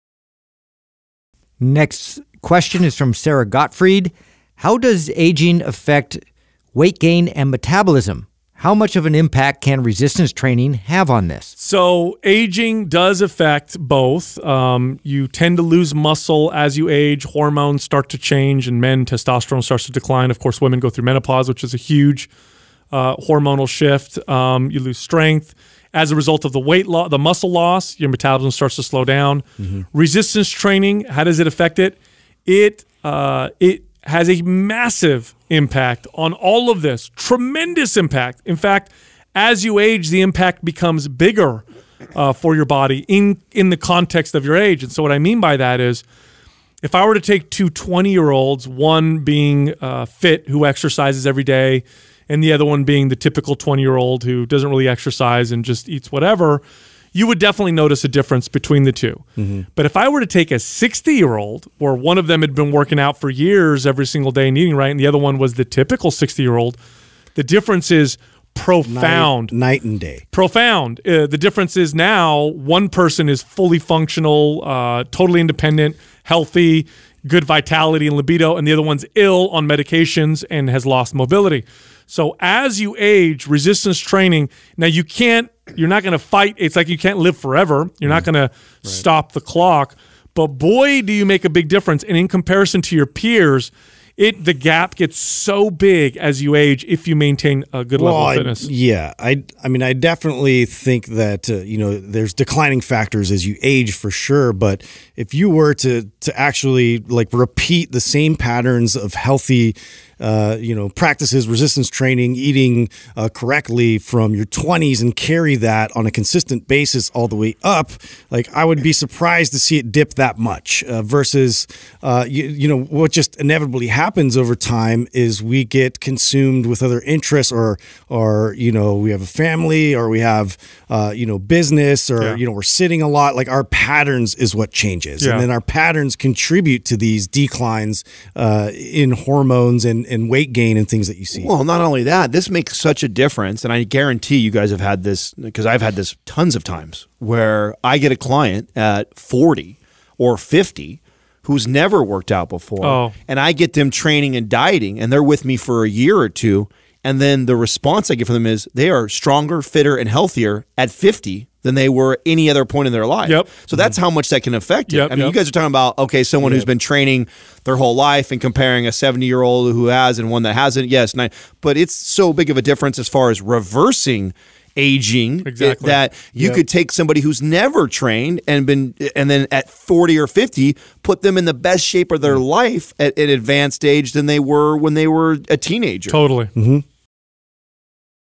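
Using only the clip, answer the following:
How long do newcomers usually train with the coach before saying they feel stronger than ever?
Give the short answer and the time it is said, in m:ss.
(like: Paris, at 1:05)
A year or two, at 2:35.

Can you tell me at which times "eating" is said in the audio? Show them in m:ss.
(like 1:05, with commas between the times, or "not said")
1:04, 1:52.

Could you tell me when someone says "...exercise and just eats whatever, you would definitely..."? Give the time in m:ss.
0:54.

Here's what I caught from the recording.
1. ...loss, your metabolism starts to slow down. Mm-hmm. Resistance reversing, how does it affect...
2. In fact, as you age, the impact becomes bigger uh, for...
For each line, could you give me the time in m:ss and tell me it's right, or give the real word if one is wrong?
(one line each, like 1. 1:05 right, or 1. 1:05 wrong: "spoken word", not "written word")
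1. 0:27 wrong: "training", not "reversing"
2. 0:38 right.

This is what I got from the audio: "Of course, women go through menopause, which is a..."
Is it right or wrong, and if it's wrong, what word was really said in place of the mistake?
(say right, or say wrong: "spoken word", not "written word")
right.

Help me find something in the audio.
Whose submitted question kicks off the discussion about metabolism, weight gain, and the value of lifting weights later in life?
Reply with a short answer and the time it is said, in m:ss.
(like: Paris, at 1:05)
Sarah Gottfried, at 0:03.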